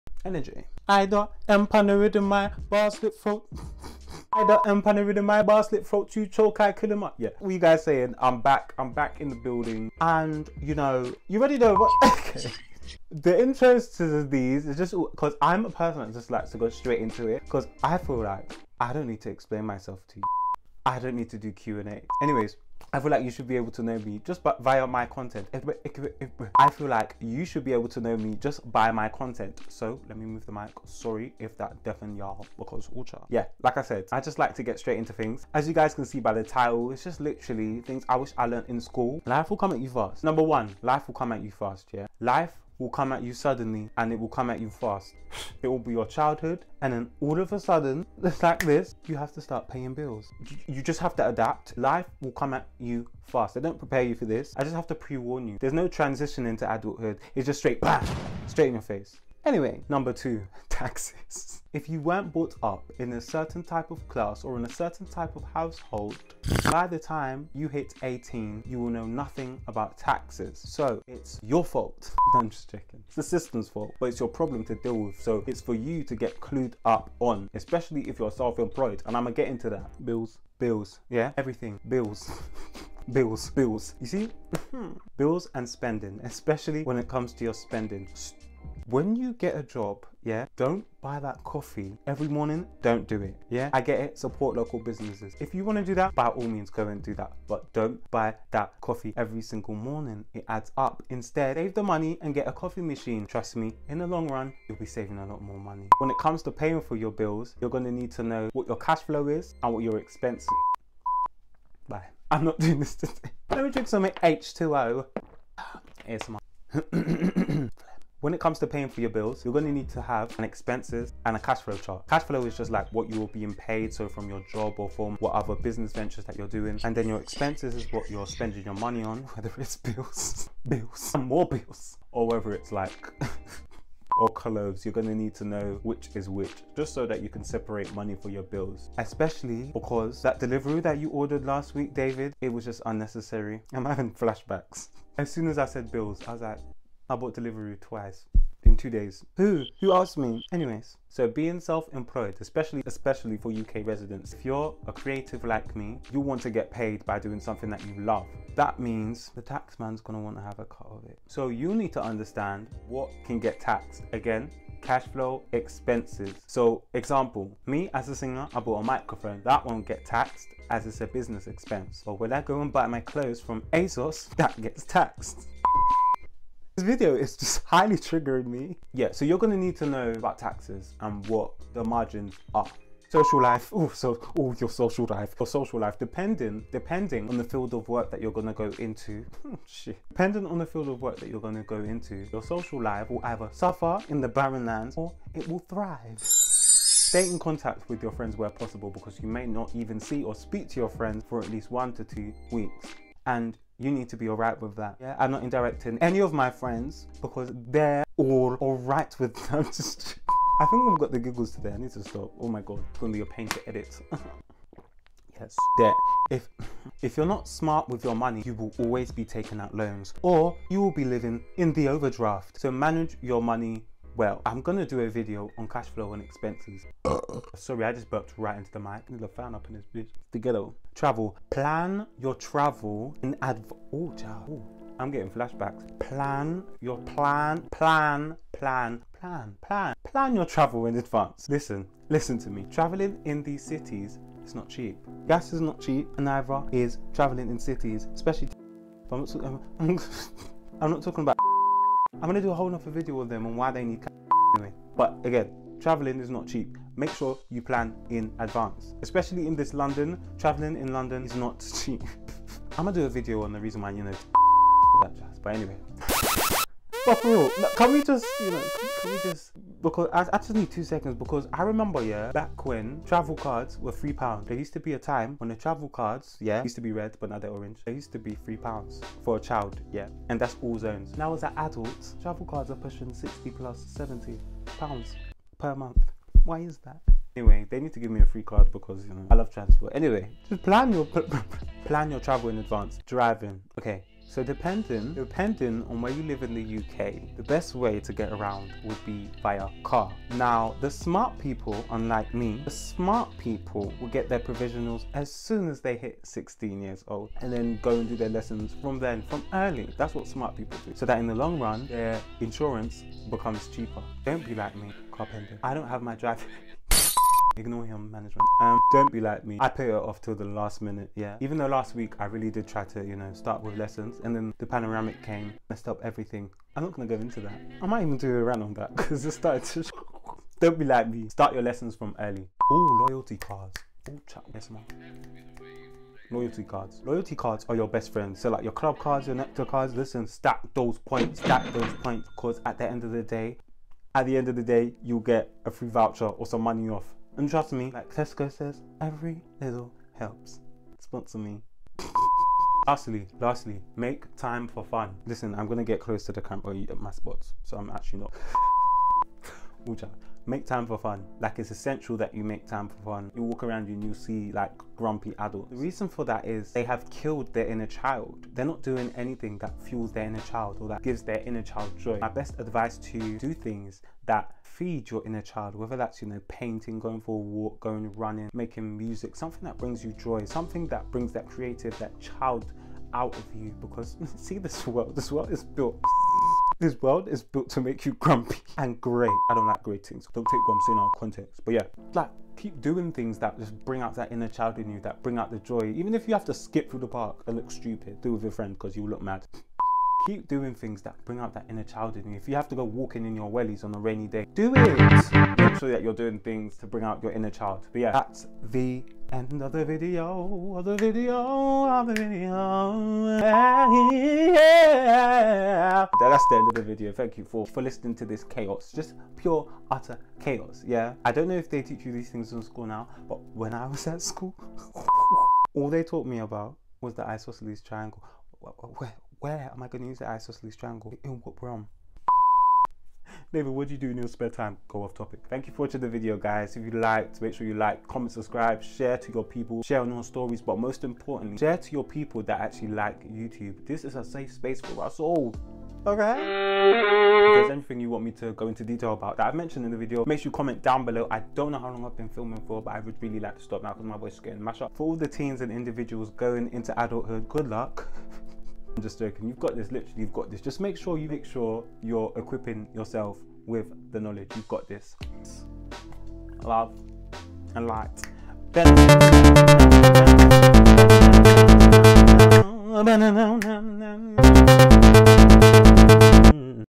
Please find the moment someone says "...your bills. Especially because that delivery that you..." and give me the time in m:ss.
2:18.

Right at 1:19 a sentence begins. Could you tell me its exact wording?
And I'm gonna get into that.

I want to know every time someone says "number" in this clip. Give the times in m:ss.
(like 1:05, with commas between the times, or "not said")
0:40, 0:59.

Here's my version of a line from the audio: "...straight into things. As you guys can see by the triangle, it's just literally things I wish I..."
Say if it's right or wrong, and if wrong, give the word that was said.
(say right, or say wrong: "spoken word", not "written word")
wrong: "title", not "triangle".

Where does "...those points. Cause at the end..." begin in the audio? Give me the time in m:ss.
5:41.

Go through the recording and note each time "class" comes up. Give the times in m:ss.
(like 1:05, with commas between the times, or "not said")
1:04.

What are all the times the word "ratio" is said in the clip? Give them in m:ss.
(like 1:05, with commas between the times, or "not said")
not said.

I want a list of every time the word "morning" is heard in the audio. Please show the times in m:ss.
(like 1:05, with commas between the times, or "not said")
1:32, 1:39.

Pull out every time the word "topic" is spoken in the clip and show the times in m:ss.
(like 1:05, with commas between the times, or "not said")
7:15.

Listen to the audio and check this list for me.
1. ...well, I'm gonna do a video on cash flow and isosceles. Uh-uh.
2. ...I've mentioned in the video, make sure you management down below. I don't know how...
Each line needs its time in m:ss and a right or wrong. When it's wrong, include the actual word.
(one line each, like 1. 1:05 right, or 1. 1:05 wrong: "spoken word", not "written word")
1. 3:44 wrong: "expenses", not "isosceles"
2. 7:29 wrong: "comment", not "management".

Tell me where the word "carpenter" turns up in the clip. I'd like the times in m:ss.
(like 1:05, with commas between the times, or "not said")
5:15.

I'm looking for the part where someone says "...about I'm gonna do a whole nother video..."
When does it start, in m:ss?
4:11.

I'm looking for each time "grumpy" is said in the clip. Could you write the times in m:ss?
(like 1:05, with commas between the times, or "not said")
6:04, 6:28.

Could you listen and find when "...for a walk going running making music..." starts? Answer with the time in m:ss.
6:17.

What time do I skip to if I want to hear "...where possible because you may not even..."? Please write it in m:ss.
3:18.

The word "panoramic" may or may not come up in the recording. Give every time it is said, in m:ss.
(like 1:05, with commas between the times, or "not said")
5:24.